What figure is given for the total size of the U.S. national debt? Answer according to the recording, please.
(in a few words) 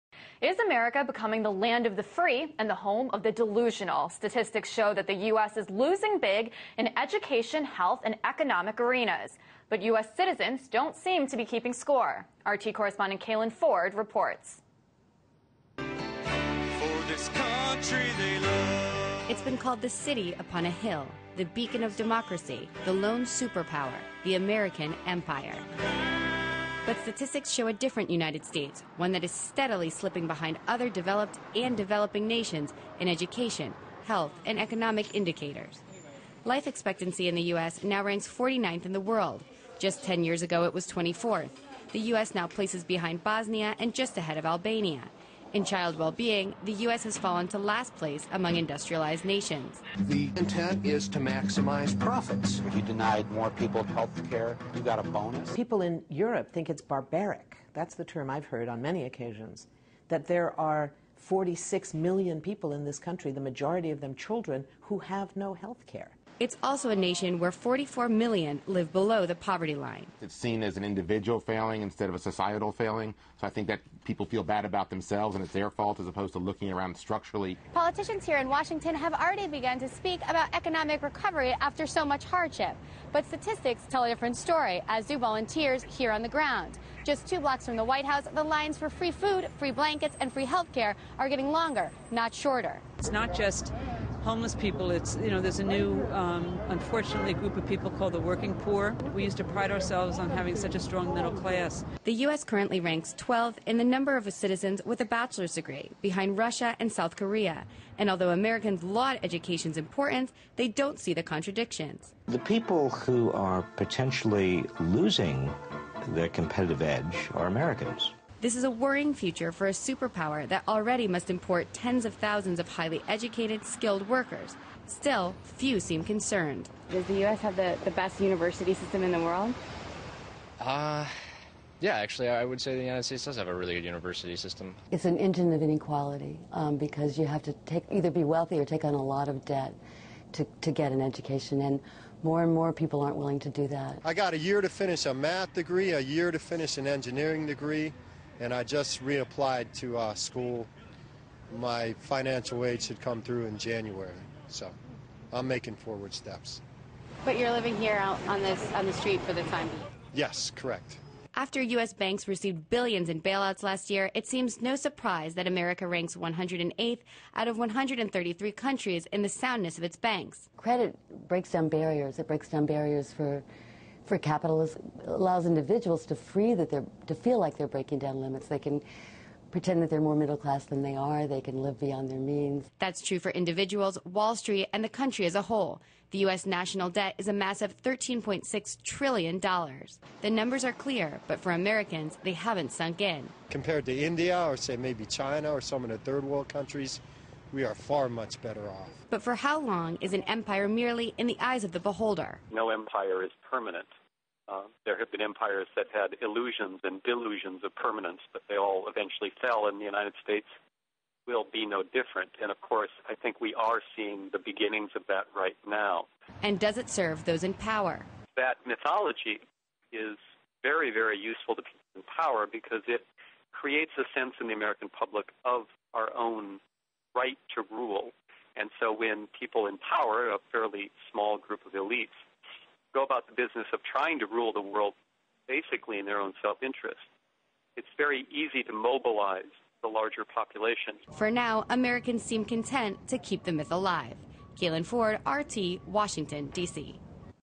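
$13.6 trillion.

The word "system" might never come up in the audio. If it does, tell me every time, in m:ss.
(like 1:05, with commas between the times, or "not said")
2:08, 2:14.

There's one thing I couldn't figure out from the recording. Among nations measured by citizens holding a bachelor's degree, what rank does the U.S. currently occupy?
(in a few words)
12.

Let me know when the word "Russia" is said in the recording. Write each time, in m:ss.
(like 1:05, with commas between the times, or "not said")
1:46.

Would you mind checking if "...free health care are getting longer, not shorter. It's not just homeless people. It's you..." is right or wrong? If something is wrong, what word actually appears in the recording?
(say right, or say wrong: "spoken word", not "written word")
right.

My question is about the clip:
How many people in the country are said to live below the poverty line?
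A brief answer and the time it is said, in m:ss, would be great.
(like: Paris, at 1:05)
44 million, at 1:07.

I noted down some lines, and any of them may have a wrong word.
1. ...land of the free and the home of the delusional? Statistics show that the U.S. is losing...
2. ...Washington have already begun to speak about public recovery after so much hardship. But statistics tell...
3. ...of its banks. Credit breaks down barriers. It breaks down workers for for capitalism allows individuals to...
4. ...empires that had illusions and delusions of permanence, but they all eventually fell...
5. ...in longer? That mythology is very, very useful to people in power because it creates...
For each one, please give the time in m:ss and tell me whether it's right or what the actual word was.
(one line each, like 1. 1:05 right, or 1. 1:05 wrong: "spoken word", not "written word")
1. 0:01 right
2. 1:18 wrong: "economic", not "public"
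3. 2:49 wrong: "barriers", not "workers"
4. 3:25 right
5. 3:37 wrong: "power", not "longer".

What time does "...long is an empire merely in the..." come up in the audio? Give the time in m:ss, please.
3:19.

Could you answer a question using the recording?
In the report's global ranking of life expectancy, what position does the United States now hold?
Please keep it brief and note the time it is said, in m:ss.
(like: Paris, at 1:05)
49th, at 0:38.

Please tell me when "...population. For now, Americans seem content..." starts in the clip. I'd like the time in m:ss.
4:00.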